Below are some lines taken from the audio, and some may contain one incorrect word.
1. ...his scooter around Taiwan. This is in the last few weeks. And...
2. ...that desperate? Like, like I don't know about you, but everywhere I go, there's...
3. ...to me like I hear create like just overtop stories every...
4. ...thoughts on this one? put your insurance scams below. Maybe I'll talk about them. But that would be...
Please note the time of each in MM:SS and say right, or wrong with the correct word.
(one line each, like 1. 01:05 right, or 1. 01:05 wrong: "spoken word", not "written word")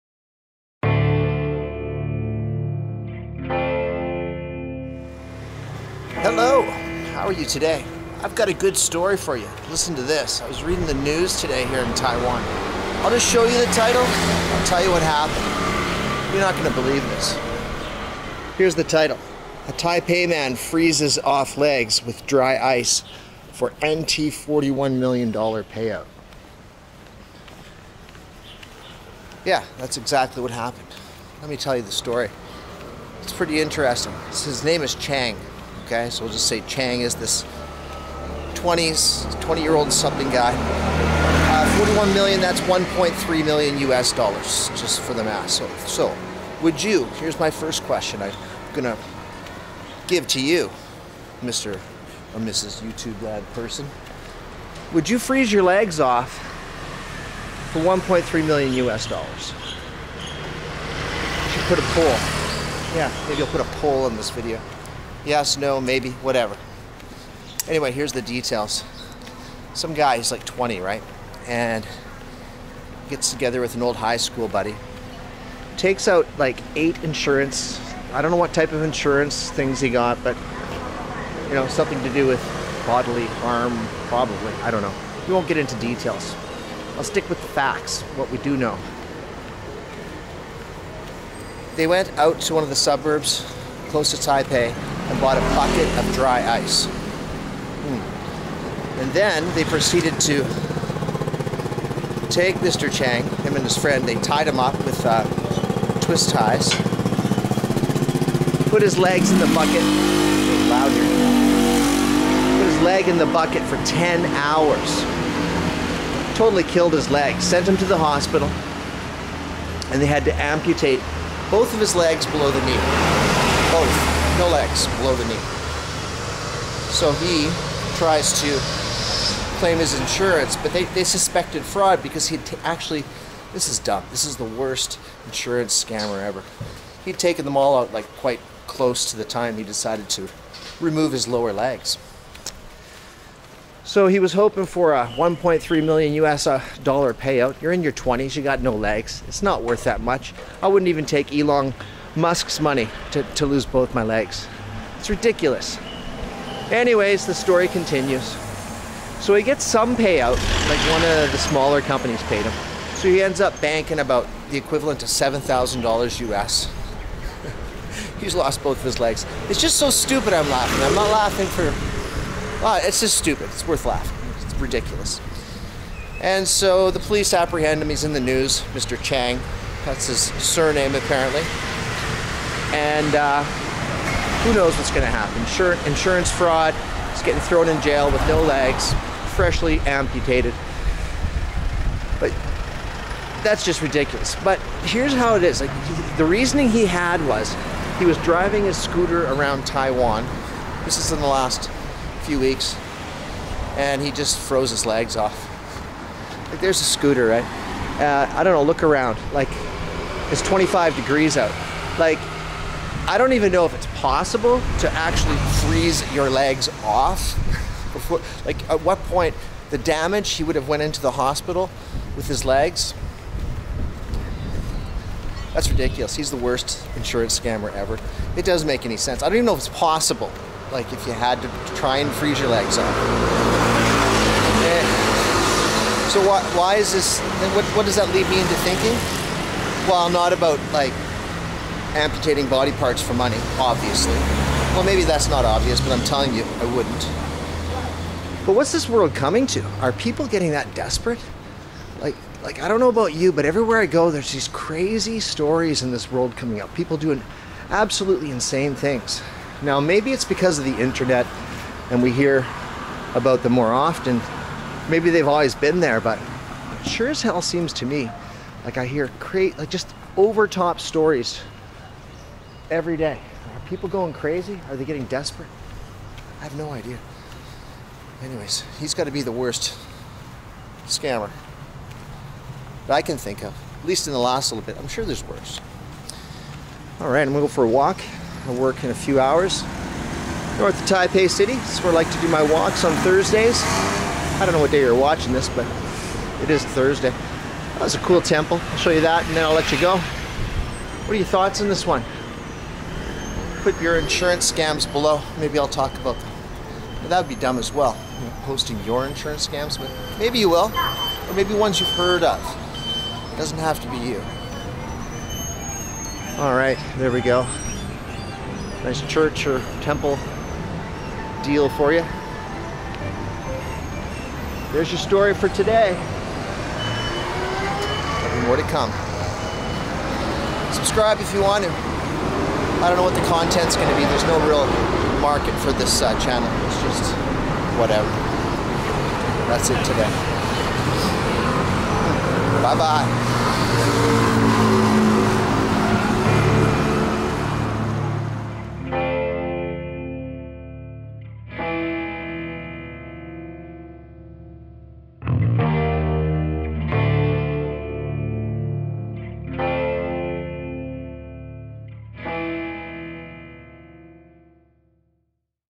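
1. 03:18 right
2. 04:10 right
3. 04:27 right
4. 05:01 right.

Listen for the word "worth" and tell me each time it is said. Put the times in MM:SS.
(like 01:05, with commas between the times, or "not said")
02:29, 02:53.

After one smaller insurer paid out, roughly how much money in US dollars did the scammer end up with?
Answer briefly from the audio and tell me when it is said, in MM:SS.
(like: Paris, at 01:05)
$7,000, at 02:45.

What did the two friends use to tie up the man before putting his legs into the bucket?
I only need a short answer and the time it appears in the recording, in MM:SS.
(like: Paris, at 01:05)
twist ties, at 01:45.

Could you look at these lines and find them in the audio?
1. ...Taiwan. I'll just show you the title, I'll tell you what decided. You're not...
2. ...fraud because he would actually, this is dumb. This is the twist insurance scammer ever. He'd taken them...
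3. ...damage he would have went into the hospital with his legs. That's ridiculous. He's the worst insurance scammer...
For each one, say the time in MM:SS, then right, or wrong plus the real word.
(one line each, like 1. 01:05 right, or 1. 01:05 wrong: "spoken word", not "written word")
1. 00:11 wrong: "happened", not "decided"
2. 02:11 wrong: "worst", not "twist"
3. 03:39 right.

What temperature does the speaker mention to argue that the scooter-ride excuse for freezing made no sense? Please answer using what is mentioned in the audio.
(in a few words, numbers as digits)
25 degrees.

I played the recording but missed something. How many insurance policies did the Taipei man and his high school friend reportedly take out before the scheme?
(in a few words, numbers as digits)
8.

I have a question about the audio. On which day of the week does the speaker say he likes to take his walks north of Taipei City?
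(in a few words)
Thursdays.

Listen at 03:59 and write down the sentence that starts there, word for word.
Well, not about like amputating body parts for money, obviously.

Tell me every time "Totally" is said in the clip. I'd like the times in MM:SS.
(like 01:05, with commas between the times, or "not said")
01:56.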